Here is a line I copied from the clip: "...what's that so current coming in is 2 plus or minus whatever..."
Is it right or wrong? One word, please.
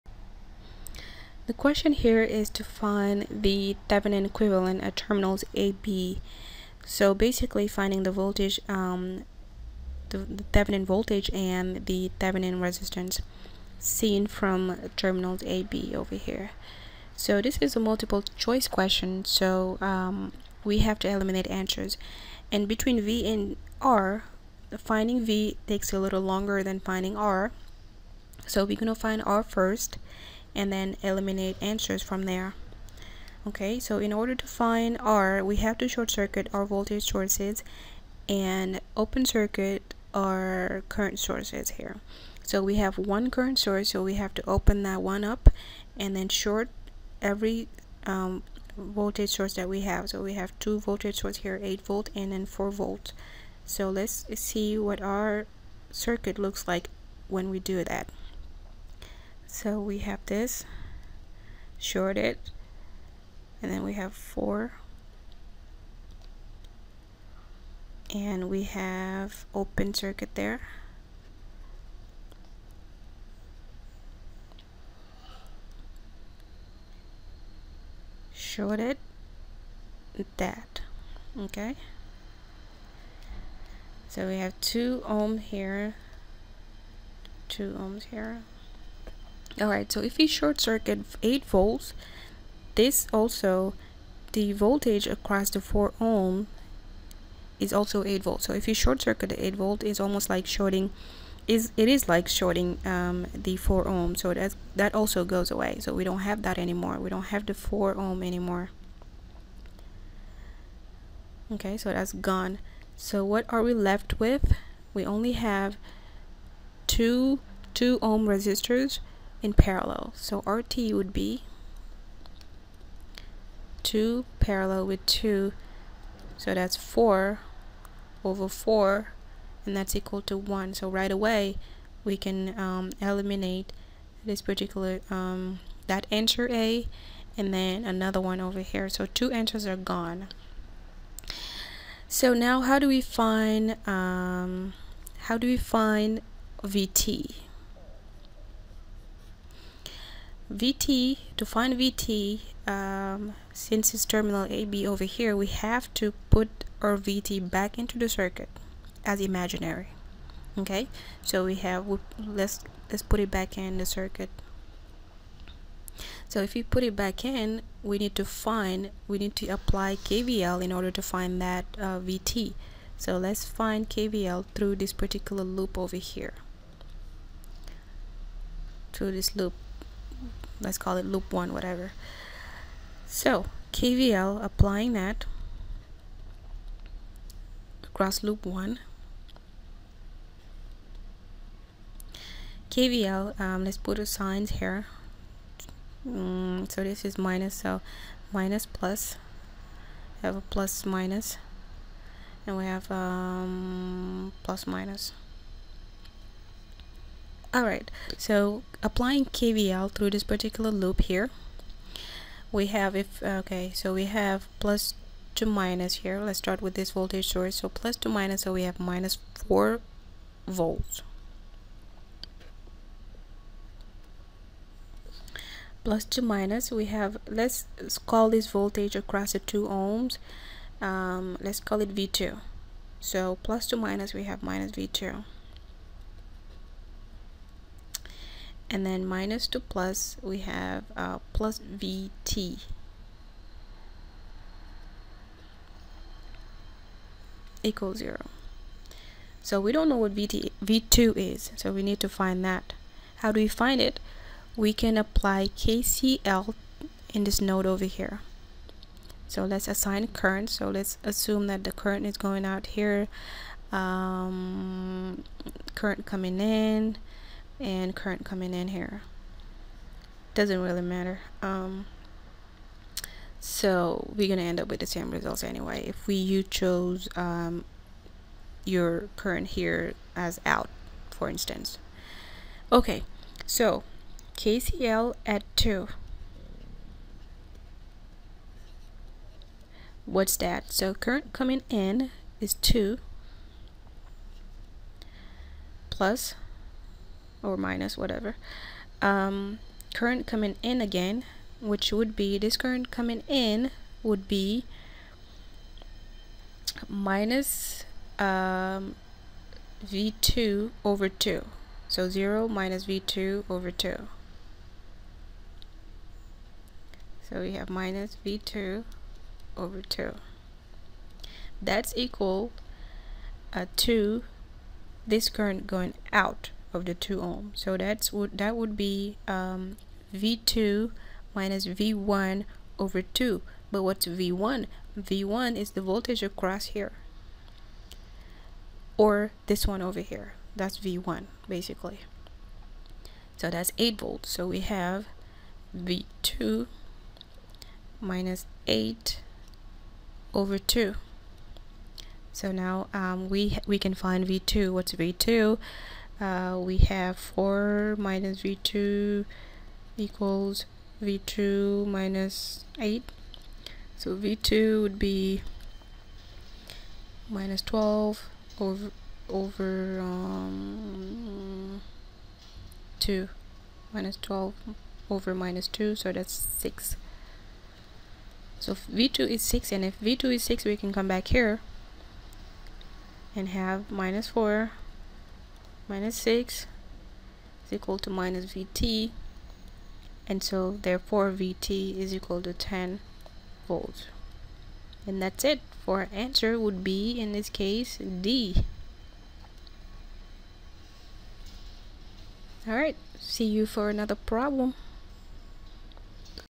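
right.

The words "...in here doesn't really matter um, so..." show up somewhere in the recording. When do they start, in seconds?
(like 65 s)
268 s.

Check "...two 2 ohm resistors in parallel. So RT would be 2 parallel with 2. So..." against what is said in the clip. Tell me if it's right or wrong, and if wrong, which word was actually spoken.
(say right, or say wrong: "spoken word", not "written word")
right.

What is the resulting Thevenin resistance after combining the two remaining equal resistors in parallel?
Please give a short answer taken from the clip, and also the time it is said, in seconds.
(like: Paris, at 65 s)
1, at 129 s.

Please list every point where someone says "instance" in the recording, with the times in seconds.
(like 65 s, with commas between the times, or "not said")
281 s.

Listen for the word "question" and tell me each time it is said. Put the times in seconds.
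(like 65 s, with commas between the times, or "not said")
1 s, 18 s.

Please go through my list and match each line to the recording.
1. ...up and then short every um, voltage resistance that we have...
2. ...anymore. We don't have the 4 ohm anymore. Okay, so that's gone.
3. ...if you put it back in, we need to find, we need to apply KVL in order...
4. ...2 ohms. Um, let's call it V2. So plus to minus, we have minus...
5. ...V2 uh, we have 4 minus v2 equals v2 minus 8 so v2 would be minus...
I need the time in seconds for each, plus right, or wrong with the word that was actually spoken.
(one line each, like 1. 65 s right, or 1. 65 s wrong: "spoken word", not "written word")
1. 45 s wrong: "source", not "resistance"
2. 106 s right
3. 166 s right
4. 229 s right
5. 354 s right.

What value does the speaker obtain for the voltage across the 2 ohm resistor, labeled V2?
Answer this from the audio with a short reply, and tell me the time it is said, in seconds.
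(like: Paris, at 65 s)
6, at 376 s.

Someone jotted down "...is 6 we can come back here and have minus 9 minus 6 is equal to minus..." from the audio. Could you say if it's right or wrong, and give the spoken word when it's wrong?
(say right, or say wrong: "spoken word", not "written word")
wrong: "4", not "9".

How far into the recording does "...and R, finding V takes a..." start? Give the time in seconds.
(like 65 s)
23 s.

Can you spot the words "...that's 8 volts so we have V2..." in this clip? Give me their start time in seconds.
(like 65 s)
343 s.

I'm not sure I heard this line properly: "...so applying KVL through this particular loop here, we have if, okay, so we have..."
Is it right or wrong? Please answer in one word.
right.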